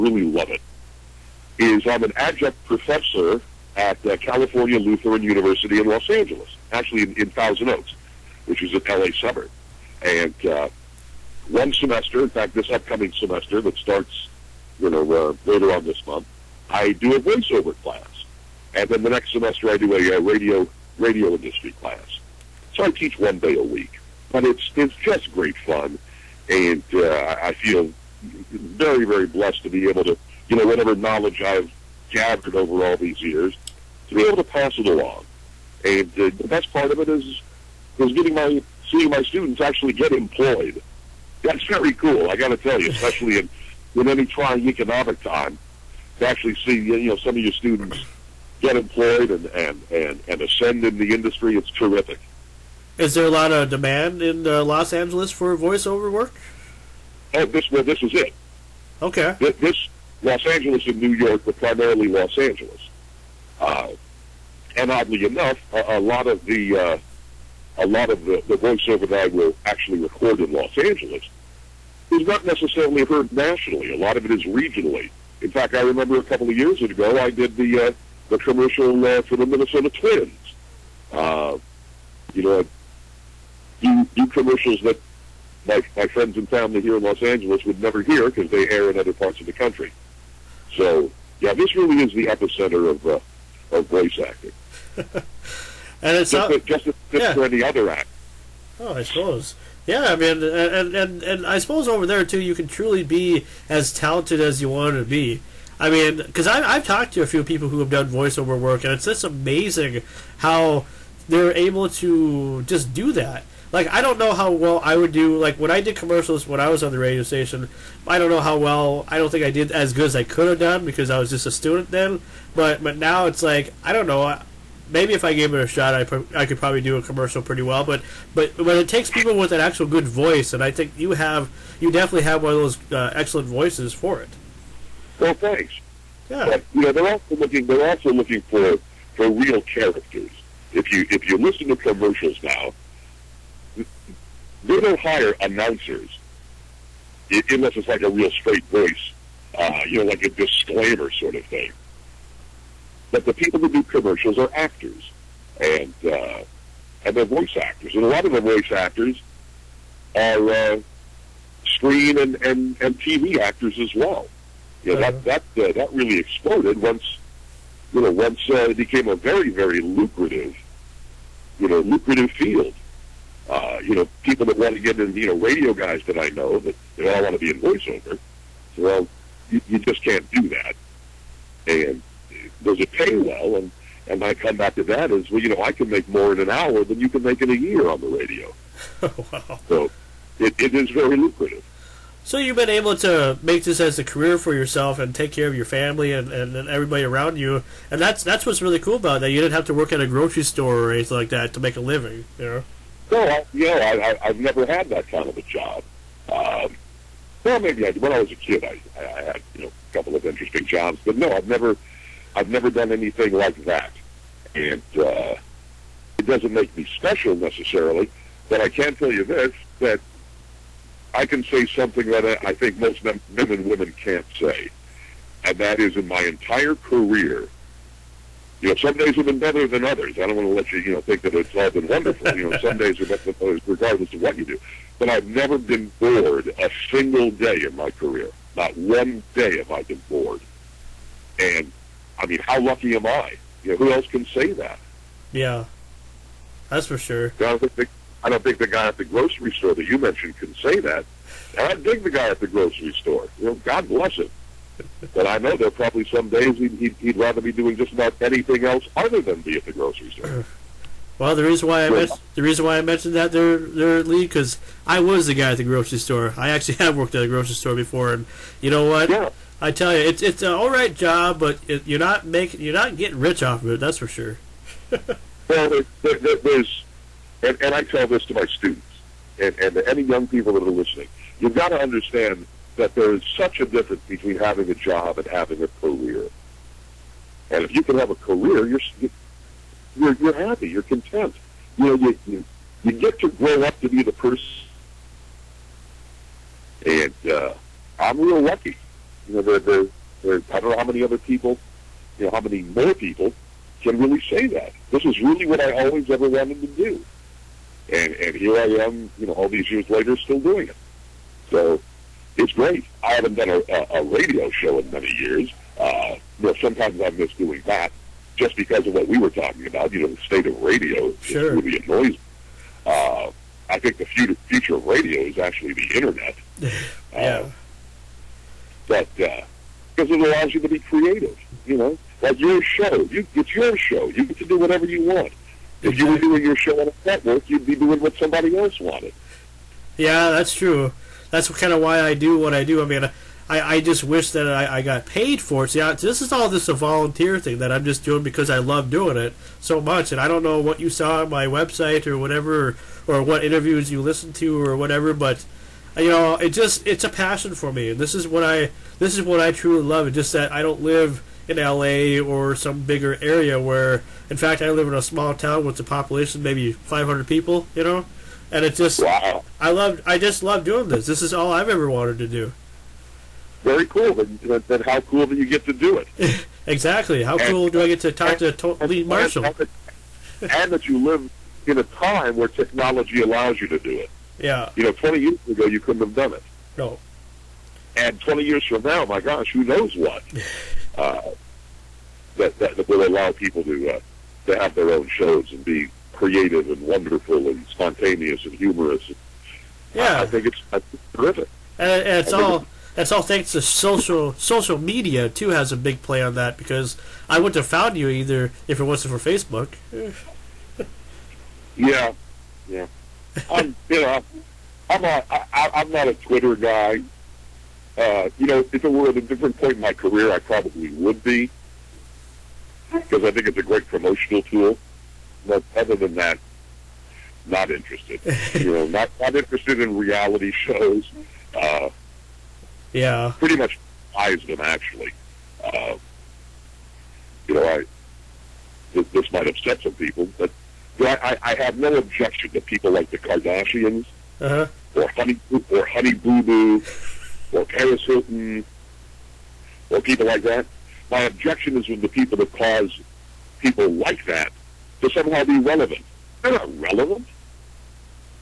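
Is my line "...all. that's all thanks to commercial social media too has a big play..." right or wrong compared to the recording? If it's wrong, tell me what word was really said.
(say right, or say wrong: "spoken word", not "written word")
wrong: "social", not "commercial".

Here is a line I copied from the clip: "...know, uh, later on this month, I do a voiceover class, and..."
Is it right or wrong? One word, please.
right.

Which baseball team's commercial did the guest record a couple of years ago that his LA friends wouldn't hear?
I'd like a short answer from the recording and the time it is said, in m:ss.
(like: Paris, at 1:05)
Minnesota Twins, at 1:19.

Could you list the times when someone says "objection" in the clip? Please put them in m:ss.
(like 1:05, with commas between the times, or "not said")
7:21, 7:31.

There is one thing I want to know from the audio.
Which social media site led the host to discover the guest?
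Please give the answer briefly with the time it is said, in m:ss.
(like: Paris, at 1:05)
Facebook, at 6:49.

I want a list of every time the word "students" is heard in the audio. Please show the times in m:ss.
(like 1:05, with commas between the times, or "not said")
0:39, 0:47, 2:01, 4:38.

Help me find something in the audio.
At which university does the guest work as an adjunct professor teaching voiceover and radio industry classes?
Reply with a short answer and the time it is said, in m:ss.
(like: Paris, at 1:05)
California Lutheran University, at 0:04.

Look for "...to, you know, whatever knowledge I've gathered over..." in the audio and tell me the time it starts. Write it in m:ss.
0:30.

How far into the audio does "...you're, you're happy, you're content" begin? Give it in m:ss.
4:49.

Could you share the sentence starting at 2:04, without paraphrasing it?
I, maybe if I gave it a shot, I, pro- I could probably do a commercial pretty well.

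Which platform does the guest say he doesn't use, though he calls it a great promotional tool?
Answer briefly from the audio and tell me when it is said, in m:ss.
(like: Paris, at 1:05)
Twitter, at 6:56.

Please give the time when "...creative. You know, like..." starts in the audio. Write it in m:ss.
5:30.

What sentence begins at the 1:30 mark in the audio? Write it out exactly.
So, yeah, this really is the epicenter of uh, of voice acting.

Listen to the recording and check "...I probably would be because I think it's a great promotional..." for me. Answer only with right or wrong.
right.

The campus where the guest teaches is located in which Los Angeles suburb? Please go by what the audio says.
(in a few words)
Thousand Oaks.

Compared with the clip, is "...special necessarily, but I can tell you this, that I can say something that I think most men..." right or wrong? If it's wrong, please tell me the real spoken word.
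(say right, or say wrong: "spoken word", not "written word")
right.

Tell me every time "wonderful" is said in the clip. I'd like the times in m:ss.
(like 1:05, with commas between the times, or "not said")
3:51, 6:36.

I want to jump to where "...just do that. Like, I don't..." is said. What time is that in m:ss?
1:52.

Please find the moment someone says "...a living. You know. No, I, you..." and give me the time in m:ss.
3:21.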